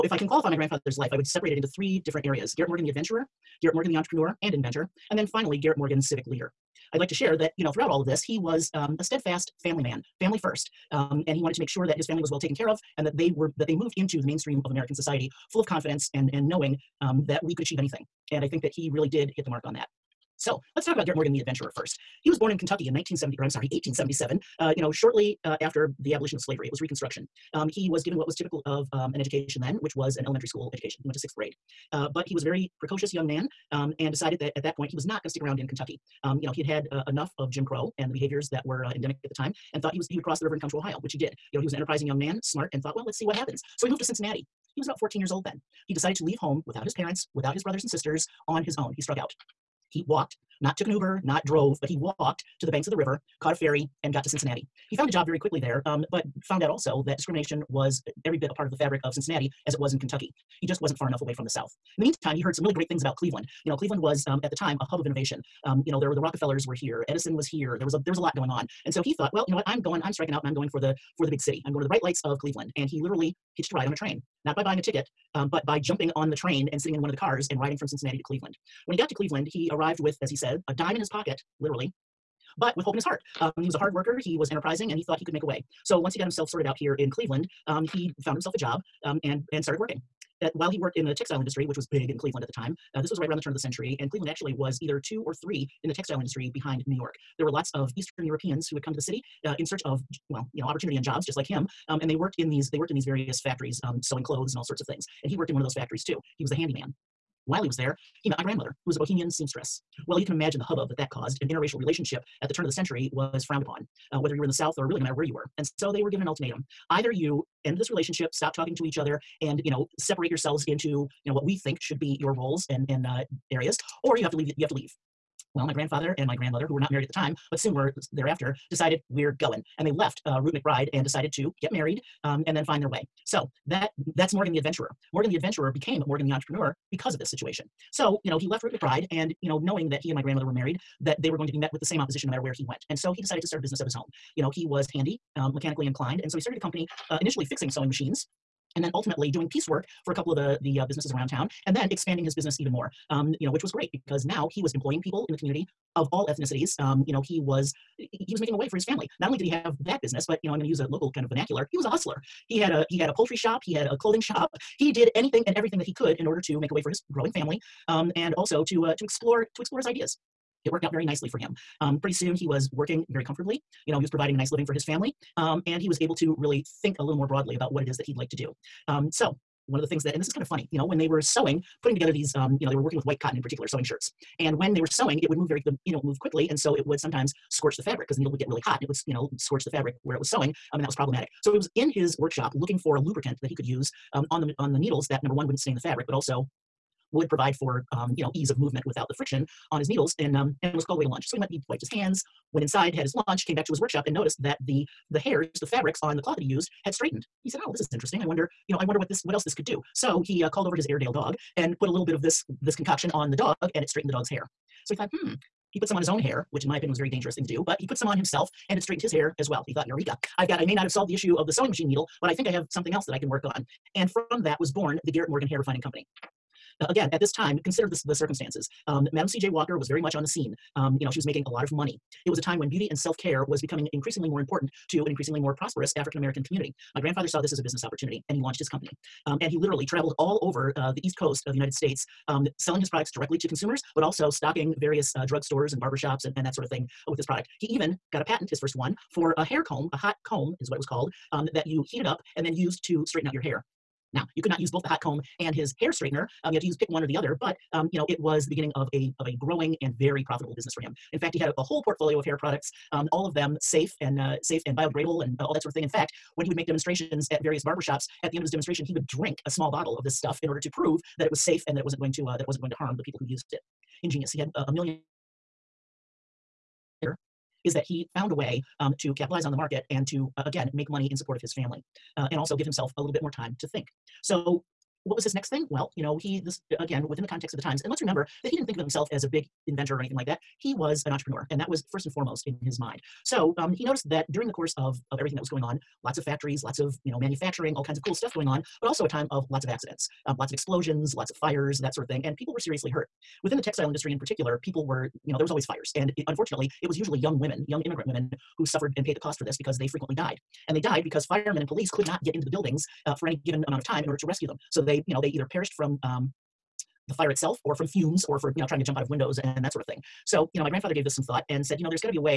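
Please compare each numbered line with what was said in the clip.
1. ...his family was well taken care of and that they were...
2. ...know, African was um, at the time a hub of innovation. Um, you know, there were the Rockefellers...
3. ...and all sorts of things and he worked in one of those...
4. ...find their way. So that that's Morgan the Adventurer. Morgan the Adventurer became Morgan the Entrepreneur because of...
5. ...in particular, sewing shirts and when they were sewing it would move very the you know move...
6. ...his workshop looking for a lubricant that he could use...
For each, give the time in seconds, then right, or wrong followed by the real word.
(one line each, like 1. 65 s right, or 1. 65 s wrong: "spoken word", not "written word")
1. 11 s right
2. 63 s wrong: "Cleveland", not "African"
3. 104 s right
4. 132 s right
5. 183 s right
6. 191 s right.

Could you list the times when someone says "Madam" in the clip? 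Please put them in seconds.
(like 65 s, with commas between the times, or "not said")
229 s.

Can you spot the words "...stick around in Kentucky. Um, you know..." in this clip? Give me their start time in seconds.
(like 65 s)
35 s.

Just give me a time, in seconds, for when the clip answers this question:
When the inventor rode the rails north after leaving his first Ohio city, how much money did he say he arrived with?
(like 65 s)
80 s.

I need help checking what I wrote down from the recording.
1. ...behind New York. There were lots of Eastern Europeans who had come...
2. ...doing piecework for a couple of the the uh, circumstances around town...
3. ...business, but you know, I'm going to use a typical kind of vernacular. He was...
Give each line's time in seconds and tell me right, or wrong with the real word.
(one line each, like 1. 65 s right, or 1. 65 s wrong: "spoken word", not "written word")
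1. 96 s right
2. 149 s wrong: "businesses", not "circumstances"
3. 160 s wrong: "local", not "typical".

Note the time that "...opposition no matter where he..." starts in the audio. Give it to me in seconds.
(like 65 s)
141 s.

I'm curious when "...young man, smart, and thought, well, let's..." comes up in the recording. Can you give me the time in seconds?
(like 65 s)
42 s.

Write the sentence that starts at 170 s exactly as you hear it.
It worked out very nicely for him.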